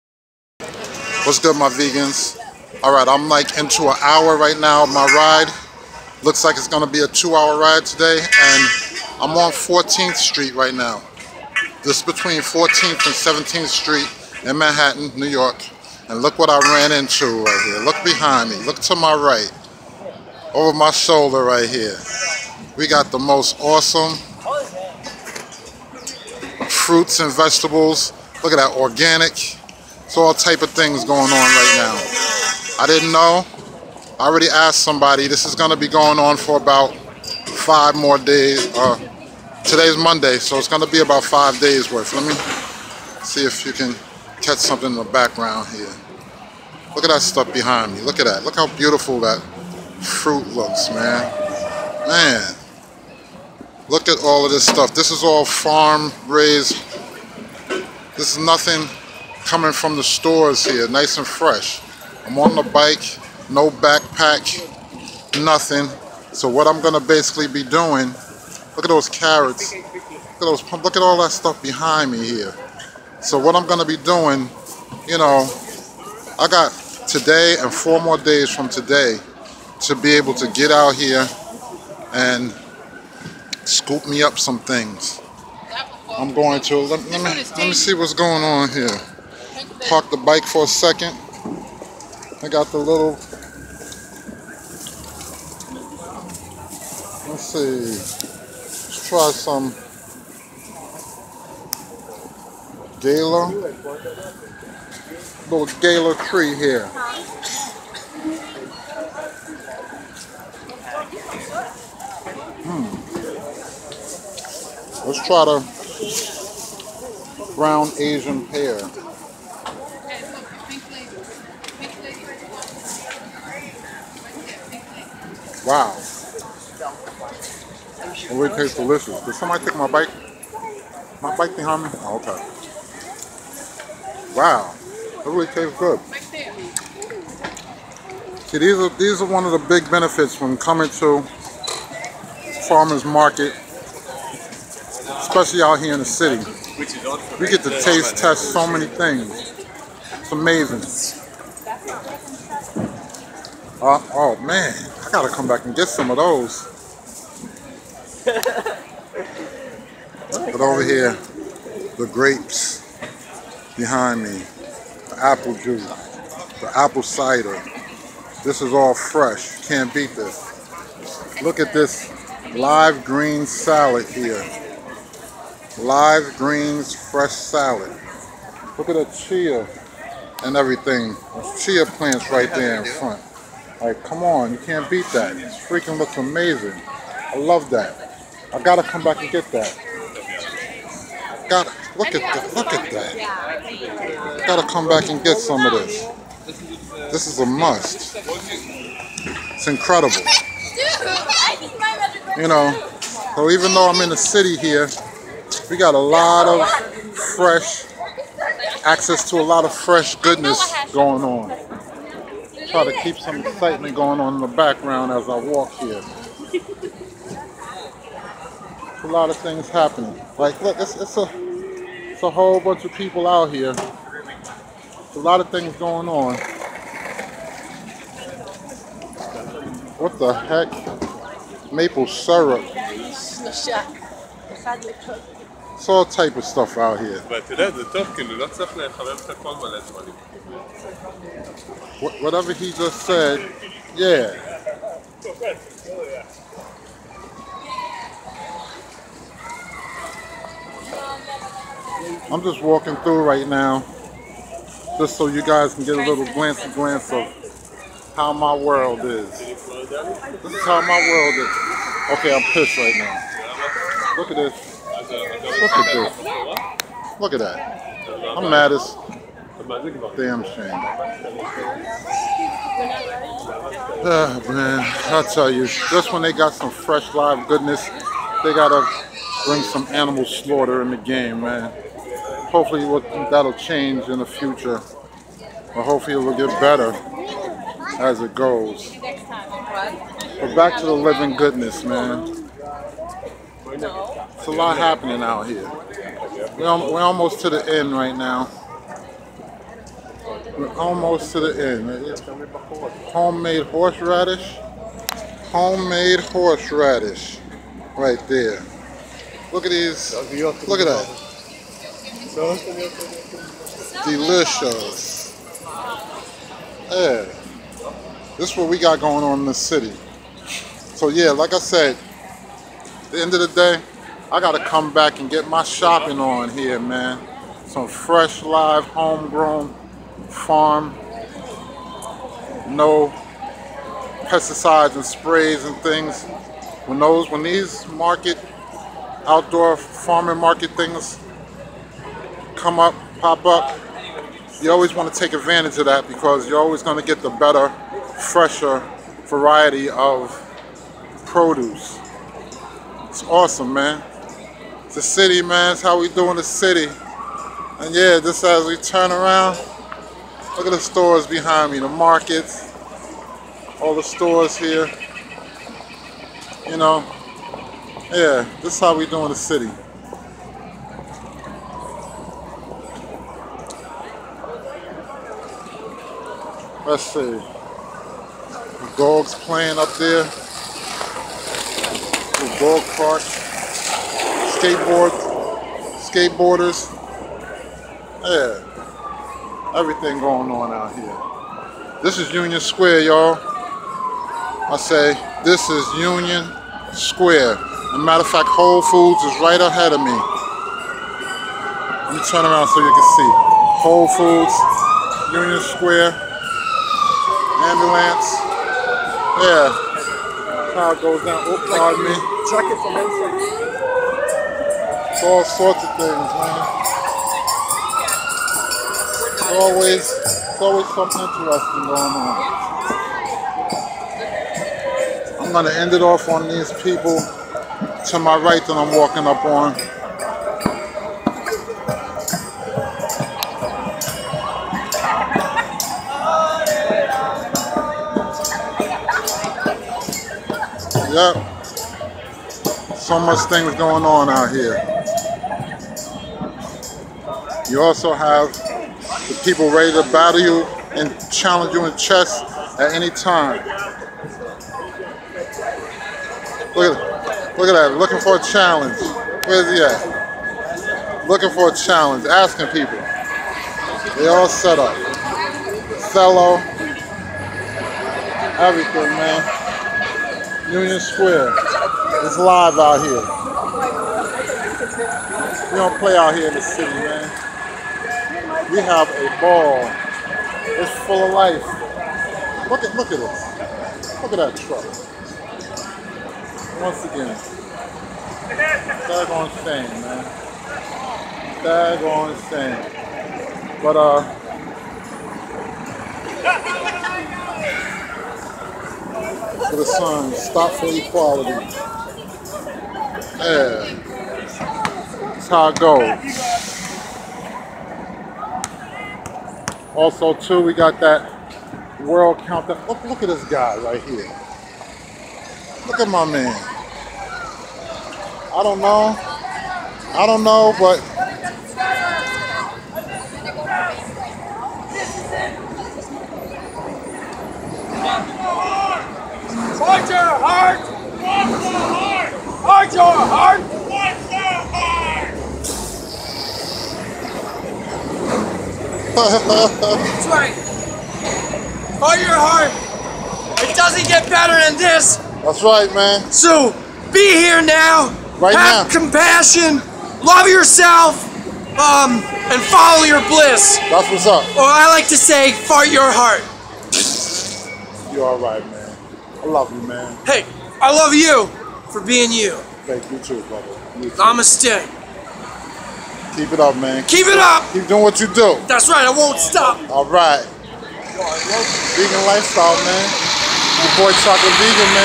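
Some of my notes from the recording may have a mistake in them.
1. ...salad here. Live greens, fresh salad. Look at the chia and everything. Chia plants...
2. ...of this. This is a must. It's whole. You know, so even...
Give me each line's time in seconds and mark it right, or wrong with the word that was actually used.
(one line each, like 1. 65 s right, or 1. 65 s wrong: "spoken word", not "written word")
1. 173 s right
2. 195 s wrong: "incredible", not "whole".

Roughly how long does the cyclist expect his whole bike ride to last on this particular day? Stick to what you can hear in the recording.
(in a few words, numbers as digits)
2 hours.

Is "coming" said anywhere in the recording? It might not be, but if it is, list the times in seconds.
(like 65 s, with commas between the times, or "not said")
59 s, 140 s.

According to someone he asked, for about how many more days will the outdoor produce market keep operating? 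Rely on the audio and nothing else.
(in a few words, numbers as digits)
5 days.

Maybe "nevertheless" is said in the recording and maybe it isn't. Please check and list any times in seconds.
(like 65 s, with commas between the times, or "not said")
not said.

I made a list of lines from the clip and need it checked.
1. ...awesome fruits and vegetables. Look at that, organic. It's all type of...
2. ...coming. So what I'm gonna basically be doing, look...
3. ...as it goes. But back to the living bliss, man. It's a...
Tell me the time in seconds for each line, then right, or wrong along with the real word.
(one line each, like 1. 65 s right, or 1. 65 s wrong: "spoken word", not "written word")
1. 23 s right
2. 65 s wrong: "nothing", not "coming"
3. 288 s wrong: "goodness", not "bliss".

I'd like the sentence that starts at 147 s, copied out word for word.
We get to taste test so many things.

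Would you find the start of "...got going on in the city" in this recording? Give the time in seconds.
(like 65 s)
318 s.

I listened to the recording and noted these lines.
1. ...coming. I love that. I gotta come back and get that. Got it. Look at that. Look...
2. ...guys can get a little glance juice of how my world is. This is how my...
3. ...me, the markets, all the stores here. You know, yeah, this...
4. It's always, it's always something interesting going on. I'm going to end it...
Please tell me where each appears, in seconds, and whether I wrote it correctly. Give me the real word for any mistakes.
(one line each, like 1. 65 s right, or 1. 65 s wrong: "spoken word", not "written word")
1. 186 s wrong: "amazing", not "coming"
2. 255 s wrong: "glance", not "juice"
3. 361 s right
4. 419 s right.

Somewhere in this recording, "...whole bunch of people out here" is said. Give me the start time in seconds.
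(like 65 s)
222 s.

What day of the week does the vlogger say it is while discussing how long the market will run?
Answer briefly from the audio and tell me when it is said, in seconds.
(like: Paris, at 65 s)
Monday, at 39 s.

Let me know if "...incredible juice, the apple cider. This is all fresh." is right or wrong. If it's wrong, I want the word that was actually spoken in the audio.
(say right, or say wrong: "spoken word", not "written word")
wrong: "apple", not "incredible".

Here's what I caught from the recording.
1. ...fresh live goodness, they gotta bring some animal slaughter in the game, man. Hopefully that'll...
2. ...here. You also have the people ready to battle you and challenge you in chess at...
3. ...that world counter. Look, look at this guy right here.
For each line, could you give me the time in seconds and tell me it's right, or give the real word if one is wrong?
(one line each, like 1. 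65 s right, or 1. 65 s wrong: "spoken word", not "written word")
1. 276 s right
2. 444 s right
3. 510 s right.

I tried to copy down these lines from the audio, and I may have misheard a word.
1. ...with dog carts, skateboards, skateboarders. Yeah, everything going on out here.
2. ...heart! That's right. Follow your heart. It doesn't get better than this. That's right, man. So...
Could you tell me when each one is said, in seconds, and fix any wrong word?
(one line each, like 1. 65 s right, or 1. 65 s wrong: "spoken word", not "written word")
1. 382 s right
2. 534 s right.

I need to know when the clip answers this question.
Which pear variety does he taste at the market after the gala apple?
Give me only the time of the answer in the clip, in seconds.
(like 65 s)
117 s.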